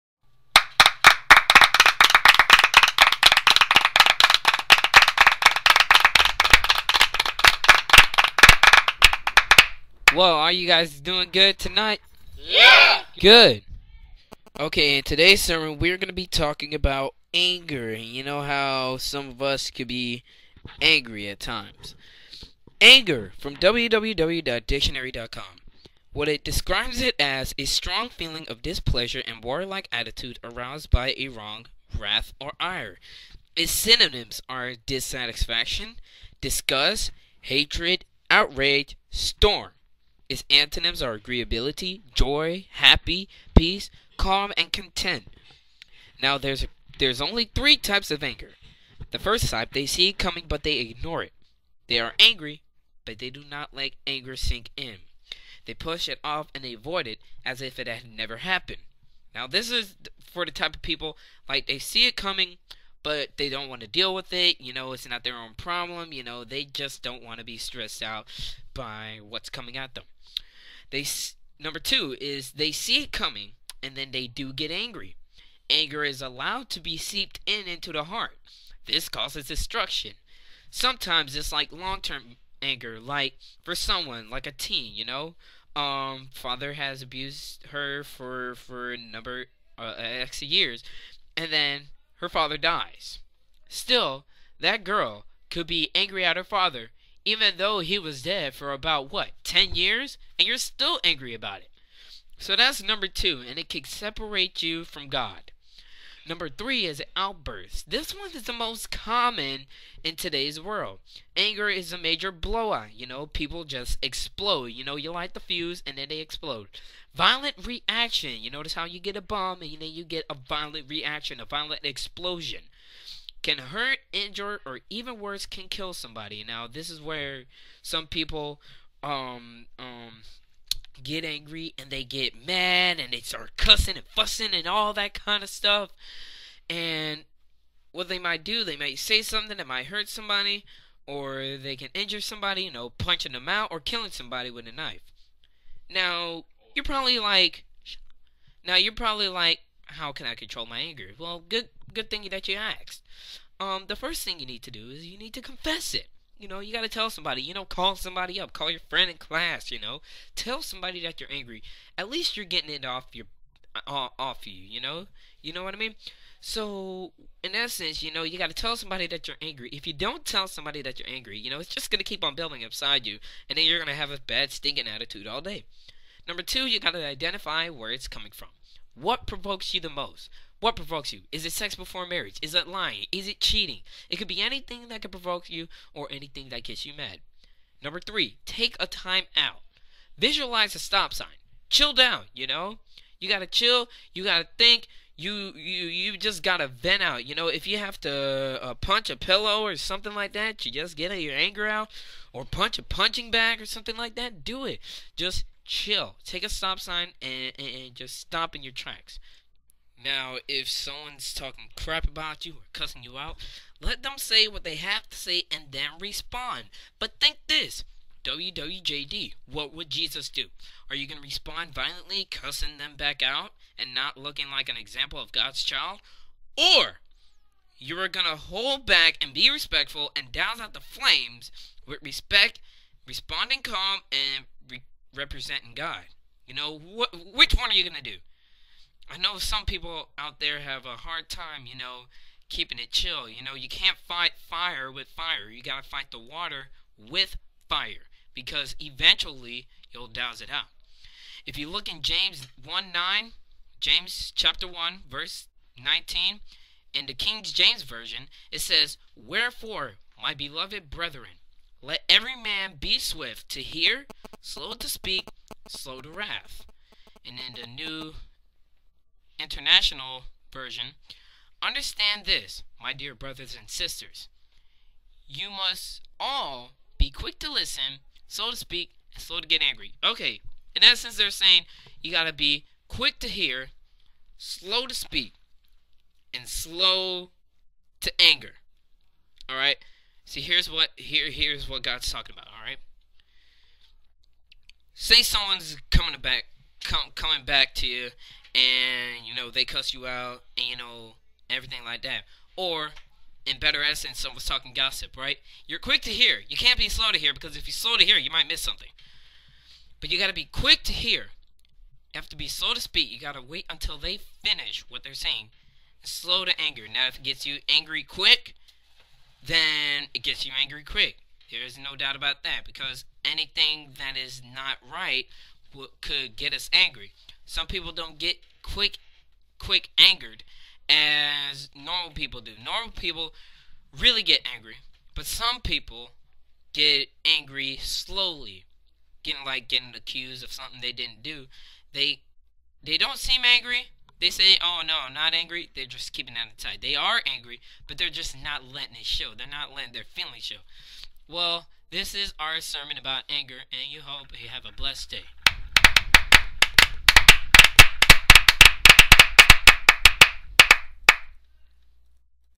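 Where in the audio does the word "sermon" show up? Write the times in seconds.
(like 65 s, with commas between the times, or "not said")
15 s, 352 s.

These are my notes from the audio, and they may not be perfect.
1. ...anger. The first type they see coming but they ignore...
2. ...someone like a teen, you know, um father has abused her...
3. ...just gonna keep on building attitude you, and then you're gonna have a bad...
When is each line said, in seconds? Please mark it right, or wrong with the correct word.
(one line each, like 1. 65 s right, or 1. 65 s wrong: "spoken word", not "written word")
1. 48 s right
2. 83 s right
3. 171 s wrong: "inside", not "attitude".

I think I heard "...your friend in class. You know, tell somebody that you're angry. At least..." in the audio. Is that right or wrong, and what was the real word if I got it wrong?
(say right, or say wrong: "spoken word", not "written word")
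right.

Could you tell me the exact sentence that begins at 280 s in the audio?
Okay, in essence, they're saying you gotta be quick to hear, slow to speak, and slow to anger.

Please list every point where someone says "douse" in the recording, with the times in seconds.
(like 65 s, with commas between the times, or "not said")
230 s, 250 s.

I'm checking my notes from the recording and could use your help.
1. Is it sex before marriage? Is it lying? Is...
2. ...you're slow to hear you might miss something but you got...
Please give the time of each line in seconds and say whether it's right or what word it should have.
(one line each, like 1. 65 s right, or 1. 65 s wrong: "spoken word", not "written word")
1. 181 s right
2. 307 s right.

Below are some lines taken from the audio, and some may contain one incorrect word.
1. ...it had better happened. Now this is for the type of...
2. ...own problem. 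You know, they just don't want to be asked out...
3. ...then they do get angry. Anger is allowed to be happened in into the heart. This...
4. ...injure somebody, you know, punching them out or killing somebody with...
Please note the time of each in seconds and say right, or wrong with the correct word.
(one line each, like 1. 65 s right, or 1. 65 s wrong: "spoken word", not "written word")
1. 57 s wrong: "never", not "better"
2. 65 s wrong: "stressed", not "asked"
3. 73 s wrong: "seeped", not "happened"
4. 141 s right.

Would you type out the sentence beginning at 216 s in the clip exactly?
But think this WWJD, what would Jesus do?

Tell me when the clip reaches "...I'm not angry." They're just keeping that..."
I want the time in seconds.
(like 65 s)
345 s.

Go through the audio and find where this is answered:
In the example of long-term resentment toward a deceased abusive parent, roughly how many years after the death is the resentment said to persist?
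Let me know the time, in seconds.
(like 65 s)
99 s.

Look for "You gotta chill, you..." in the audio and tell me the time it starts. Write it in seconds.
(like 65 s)
193 s.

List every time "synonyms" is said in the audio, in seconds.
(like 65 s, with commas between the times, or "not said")
33 s.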